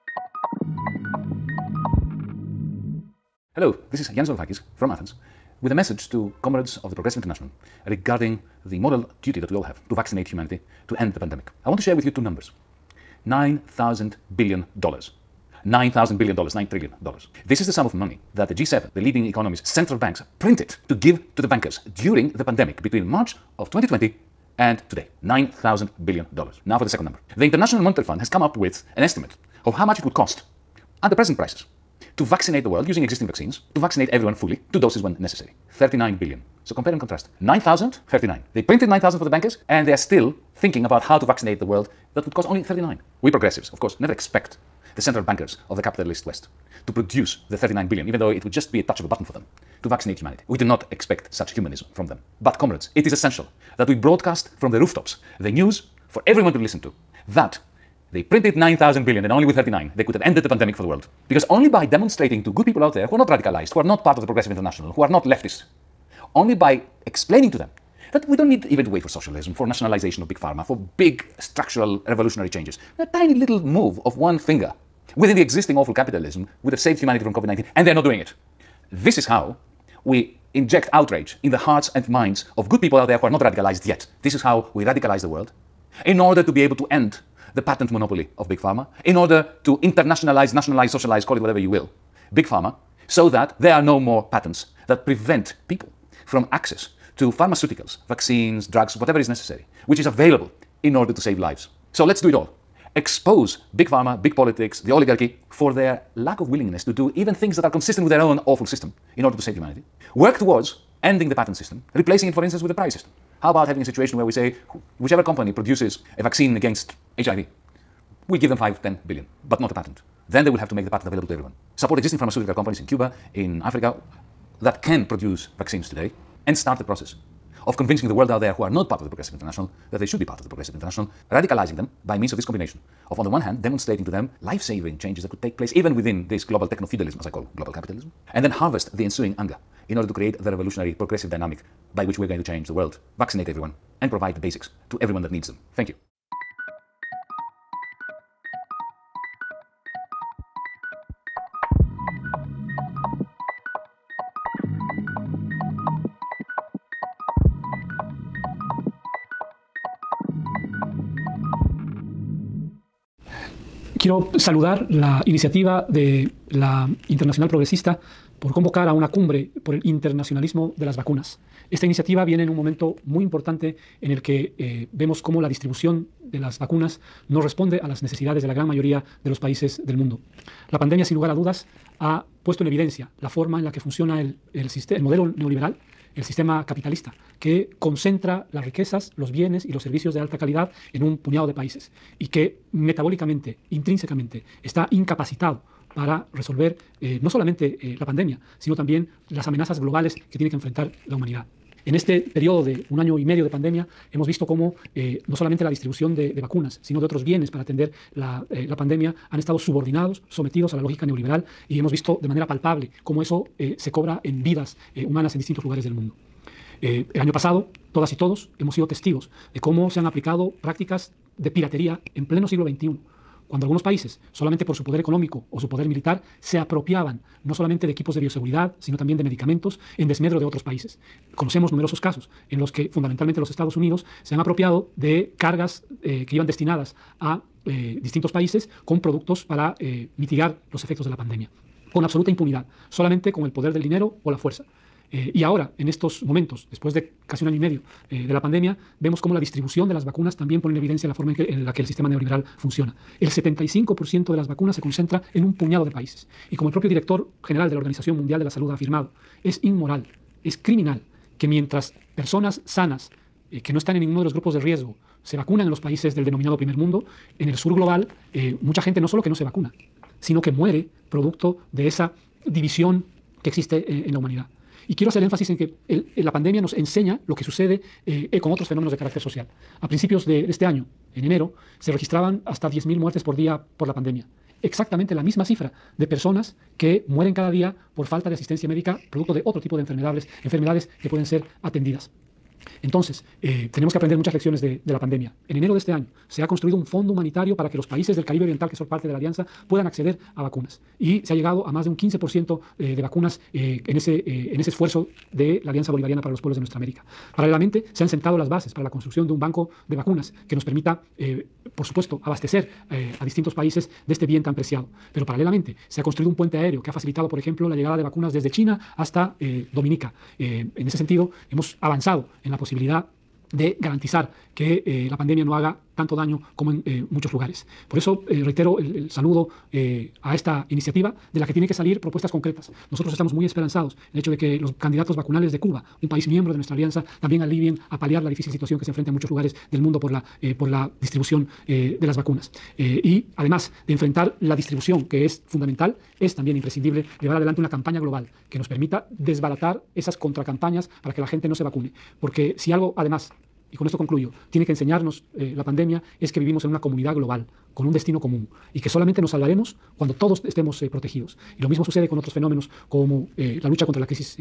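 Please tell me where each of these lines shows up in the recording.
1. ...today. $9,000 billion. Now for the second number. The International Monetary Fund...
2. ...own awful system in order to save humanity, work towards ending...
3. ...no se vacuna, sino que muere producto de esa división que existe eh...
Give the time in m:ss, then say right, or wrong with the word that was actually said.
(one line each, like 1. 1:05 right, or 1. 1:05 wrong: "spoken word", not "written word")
1. 0:24 right
2. 1:48 right
3. 4:29 right.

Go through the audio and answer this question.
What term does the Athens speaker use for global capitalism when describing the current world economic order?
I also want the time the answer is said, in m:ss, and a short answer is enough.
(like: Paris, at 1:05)
techno feudalism, at 2:16.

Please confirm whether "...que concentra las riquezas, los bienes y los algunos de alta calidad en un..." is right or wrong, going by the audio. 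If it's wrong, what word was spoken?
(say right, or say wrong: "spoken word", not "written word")
wrong: "servicios", not "algunos".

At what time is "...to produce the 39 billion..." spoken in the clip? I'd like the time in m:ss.
0:46.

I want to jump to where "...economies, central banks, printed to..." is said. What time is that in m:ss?
0:19.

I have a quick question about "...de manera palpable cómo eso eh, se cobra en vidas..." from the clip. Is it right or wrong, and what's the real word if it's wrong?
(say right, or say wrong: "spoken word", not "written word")
right.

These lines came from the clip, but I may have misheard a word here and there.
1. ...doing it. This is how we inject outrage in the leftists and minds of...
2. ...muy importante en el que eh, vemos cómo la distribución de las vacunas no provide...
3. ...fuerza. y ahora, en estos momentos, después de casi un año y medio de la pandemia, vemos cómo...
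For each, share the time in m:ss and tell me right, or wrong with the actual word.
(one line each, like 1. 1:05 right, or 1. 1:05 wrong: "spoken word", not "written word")
1. 1:18 wrong: "hearts", not "leftists"
2. 2:53 wrong: "responde", not "provide"
3. 4:04 right.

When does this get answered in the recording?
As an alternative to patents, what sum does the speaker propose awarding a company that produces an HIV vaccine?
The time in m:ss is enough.
1:58.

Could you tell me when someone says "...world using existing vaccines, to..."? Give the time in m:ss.
0:32.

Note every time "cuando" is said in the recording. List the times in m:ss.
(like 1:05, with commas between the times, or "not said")
3:43, 6:00.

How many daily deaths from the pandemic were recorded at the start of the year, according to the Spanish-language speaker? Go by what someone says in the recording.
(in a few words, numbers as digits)
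10,000.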